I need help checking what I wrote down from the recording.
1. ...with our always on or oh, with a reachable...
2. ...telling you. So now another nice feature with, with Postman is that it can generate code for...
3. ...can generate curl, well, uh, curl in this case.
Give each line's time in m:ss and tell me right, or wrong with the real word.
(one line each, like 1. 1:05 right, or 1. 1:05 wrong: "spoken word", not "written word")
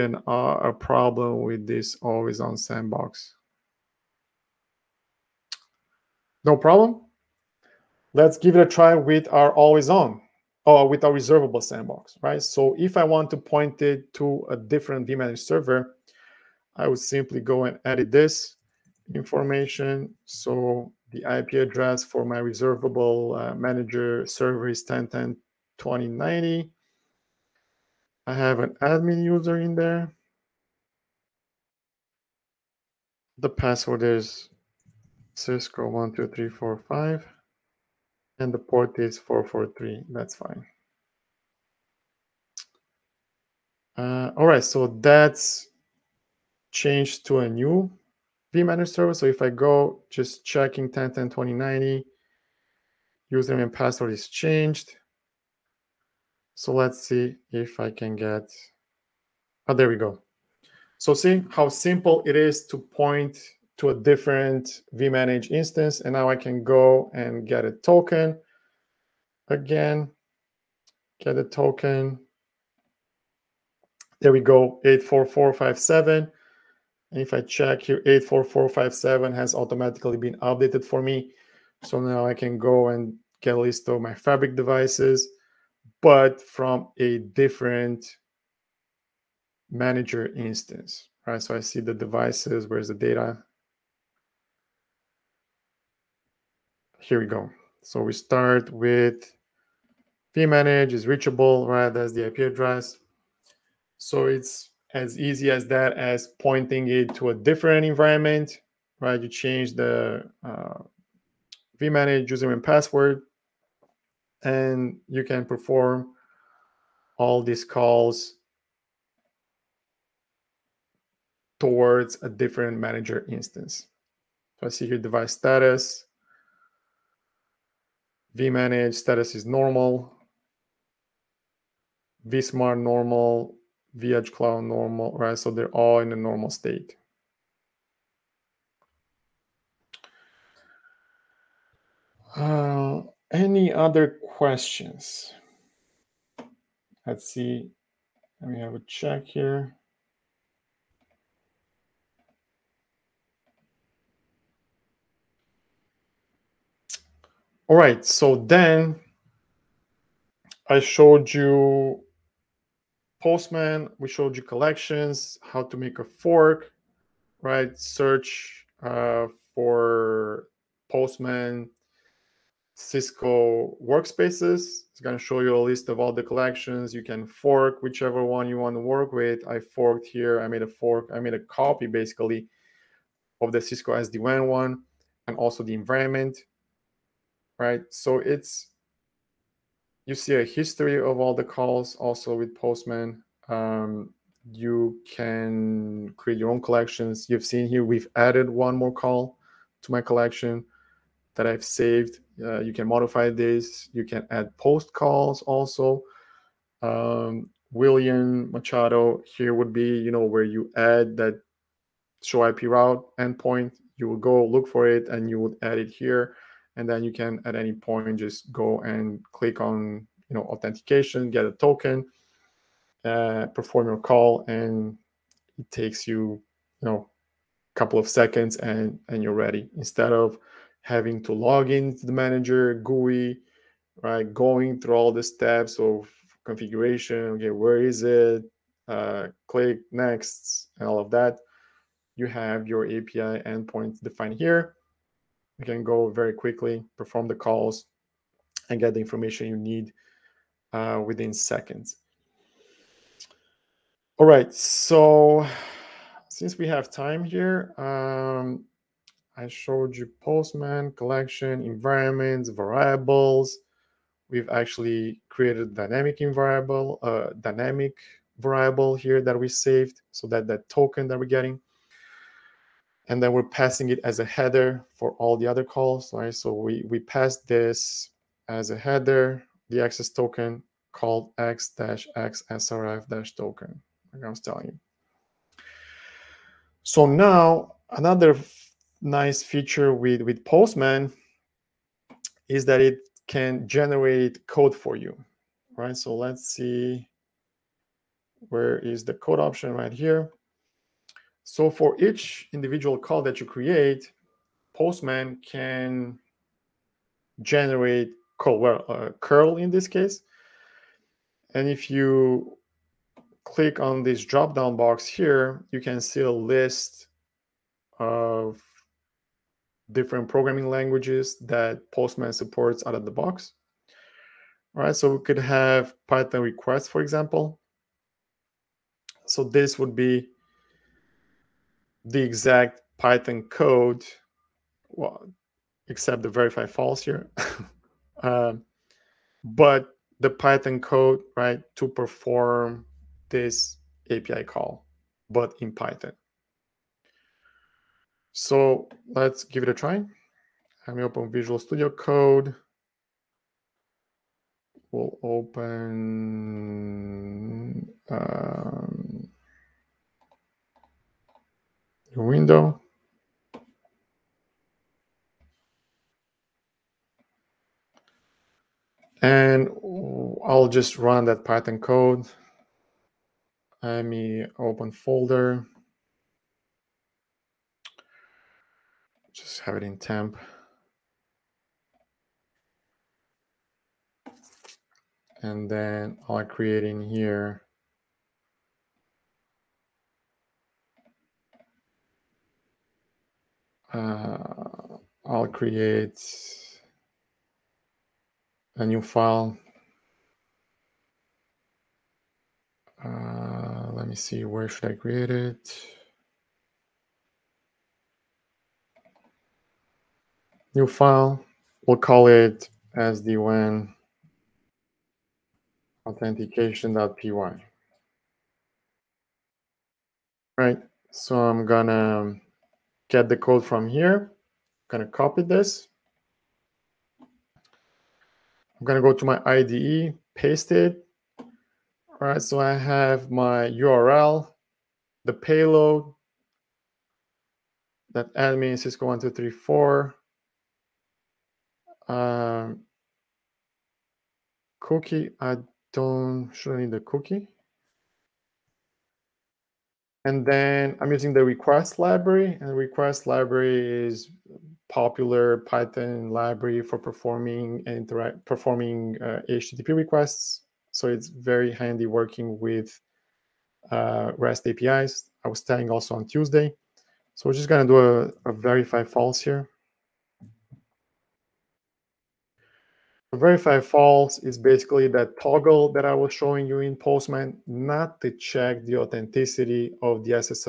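1. 0:08 wrong: "reservable", not "reachable"
2. 4:44 right
3. 5:05 right.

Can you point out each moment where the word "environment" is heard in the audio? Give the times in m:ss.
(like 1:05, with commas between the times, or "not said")
1:47, 3:05, 4:21.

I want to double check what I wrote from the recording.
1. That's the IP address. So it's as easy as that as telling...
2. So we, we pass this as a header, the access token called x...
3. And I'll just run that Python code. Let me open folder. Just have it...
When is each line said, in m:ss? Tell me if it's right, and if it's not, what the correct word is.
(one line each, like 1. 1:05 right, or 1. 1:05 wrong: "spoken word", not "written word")
1. 1:41 wrong: "pointing", not "telling"
2. 4:36 right
3. 6:09 right.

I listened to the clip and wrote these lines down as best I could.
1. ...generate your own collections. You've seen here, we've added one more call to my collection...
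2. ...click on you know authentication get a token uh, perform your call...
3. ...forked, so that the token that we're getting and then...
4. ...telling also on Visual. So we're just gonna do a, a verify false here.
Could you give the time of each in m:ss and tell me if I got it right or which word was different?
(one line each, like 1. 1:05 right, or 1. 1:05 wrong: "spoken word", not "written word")
1. 3:16 wrong: "create", not "generate"
2. 3:39 right
3. 4:29 wrong: "saved", not "forked"
4. 7:45 wrong: "Tuesday", not "Visual".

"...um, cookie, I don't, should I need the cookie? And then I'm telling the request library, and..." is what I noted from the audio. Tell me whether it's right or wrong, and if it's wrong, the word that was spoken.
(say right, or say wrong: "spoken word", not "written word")
wrong: "using", not "telling".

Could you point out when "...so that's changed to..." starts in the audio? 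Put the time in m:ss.
0:44.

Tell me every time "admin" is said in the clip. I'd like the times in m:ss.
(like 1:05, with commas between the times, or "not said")
0:28, 7:18.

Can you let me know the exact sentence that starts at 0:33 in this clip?
The password is Cisco12345 and the port is 443.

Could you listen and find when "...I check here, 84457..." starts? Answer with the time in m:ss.
1:17.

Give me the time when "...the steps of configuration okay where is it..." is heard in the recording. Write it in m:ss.
3:55.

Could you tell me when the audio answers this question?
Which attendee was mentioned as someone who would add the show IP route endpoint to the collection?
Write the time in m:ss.
3:27.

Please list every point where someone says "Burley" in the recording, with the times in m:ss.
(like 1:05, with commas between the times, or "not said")
not said.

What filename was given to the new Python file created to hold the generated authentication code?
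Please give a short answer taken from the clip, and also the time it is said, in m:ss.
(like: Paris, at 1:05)
sdwan authentication.py, at 6:52.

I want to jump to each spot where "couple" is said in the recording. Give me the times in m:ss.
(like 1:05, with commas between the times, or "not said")
3:47.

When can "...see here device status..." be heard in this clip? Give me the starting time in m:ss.
2:04.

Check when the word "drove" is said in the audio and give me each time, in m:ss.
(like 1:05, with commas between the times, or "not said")
not said.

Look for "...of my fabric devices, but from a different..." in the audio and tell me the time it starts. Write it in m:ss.
1:23.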